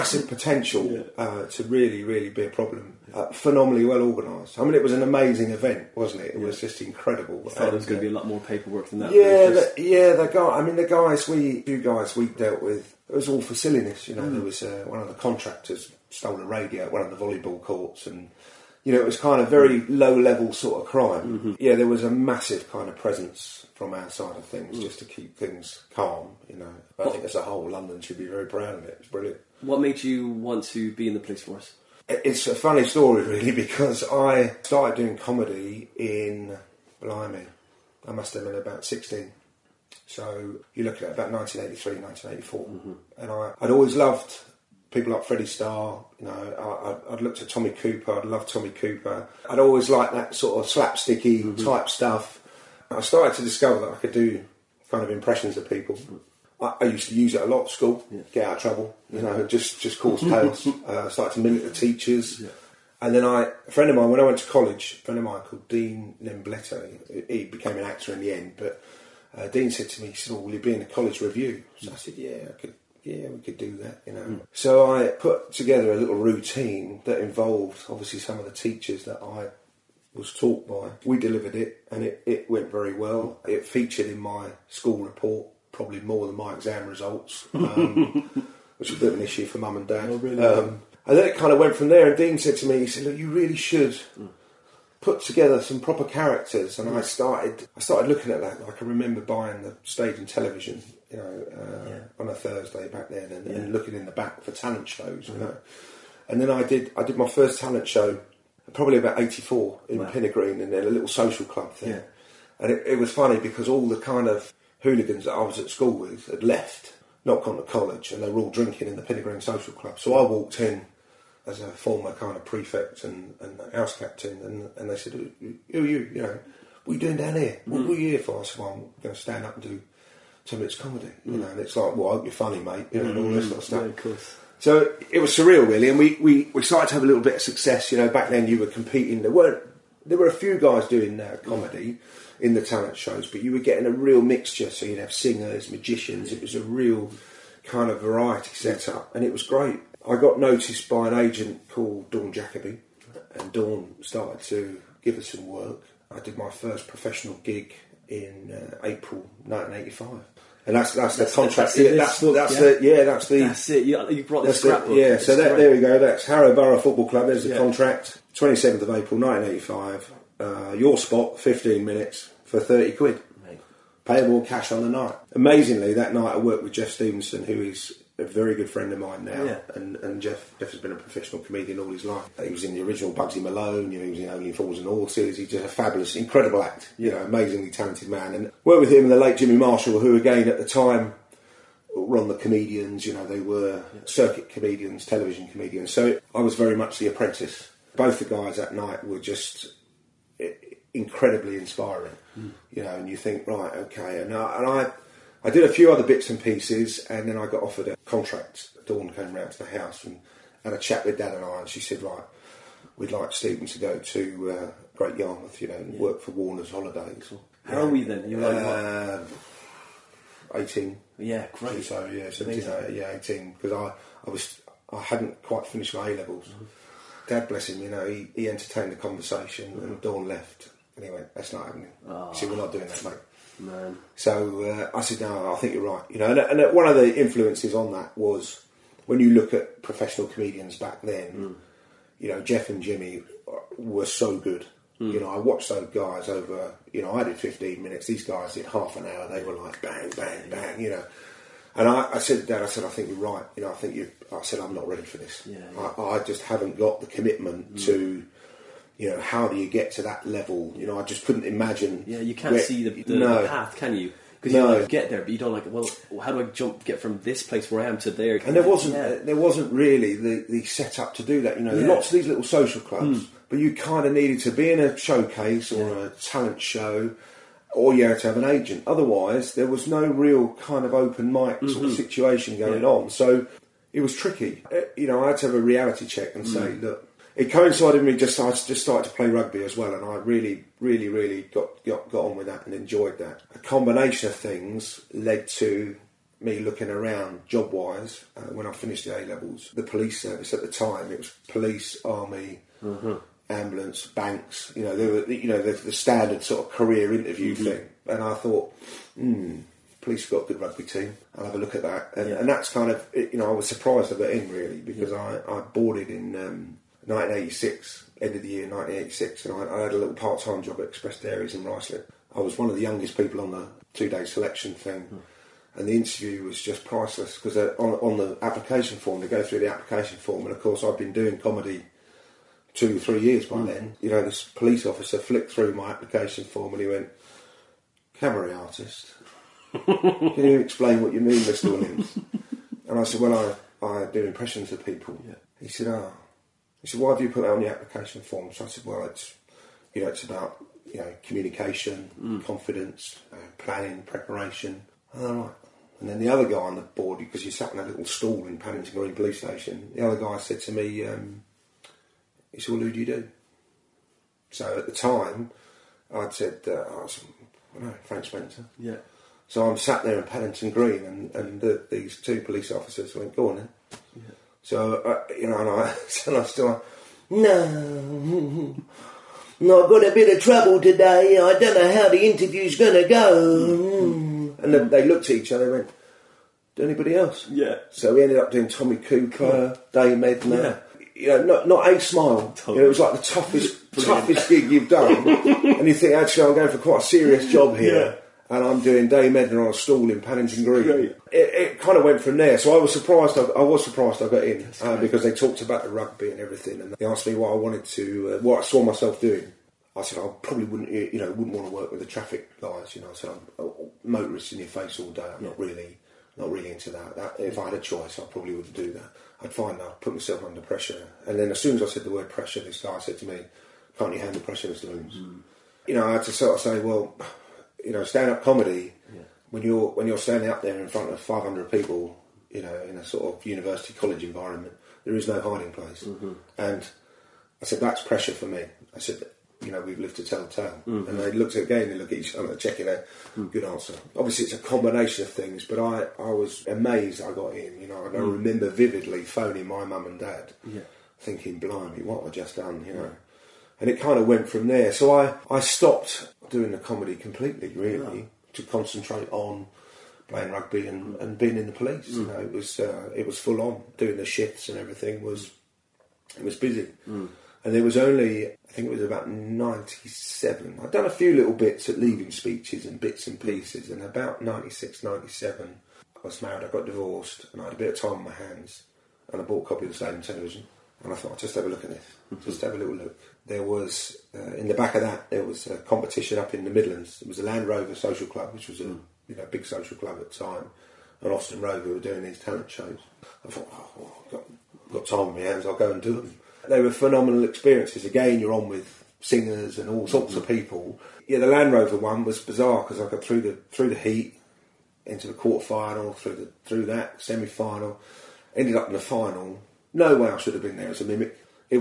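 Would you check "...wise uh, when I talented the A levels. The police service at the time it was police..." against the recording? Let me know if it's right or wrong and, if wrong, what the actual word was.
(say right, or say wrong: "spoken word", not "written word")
wrong: "finished", not "talented".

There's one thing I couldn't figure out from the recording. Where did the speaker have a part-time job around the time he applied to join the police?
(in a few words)
Express Dairies in Ruislip.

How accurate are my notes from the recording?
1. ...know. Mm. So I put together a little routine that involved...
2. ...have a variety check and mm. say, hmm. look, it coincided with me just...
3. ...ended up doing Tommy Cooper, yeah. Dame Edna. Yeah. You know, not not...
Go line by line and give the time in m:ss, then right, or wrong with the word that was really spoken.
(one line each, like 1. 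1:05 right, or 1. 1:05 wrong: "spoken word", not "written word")
1. 1:14 right
2. 4:45 wrong: "reality", not "variety"
3. 6:28 right.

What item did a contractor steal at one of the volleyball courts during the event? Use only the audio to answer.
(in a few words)
A radio.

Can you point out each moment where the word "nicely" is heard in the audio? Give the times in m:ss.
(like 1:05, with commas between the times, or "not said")
not said.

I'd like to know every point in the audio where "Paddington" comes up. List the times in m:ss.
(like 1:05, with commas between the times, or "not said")
5:58, 6:10, 6:40.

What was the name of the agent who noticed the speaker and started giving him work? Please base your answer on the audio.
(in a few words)
Dawn Jacoby.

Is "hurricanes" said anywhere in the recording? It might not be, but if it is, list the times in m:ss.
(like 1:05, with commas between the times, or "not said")
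not said.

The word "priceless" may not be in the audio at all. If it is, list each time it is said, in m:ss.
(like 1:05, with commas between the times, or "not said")
5:26.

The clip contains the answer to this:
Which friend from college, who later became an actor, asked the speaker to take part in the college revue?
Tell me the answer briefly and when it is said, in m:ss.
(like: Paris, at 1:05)
Dean Lembletto, at 1:05.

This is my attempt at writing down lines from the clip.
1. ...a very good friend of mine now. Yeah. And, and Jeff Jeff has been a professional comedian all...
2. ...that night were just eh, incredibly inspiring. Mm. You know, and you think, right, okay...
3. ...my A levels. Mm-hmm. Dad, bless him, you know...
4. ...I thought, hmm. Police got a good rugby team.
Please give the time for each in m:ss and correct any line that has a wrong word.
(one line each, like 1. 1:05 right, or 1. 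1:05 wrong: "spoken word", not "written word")
1. 2:58 right
2. 3:18 right
3. 3:45 right
4. 5:08 right.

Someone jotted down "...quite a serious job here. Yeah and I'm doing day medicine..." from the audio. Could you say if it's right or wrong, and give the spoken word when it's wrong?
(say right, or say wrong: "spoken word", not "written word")
right.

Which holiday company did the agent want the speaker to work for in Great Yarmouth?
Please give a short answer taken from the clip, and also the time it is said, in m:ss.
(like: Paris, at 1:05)
Warner's Holidays, at 3:36.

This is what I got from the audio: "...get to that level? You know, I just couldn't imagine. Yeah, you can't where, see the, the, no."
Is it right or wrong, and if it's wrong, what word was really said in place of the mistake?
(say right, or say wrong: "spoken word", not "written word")
right.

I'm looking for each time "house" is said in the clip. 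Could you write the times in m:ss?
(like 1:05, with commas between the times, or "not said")
2:03, 3:29.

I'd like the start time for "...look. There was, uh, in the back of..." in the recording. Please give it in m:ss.
8:02.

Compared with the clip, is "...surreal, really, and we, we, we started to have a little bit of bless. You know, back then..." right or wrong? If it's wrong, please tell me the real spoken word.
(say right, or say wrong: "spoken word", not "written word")
wrong: "success", not "bless".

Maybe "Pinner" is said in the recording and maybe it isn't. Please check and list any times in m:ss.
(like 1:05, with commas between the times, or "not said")
1:50, 1:59.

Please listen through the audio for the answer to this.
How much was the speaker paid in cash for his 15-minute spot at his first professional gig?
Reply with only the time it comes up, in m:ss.
2:52.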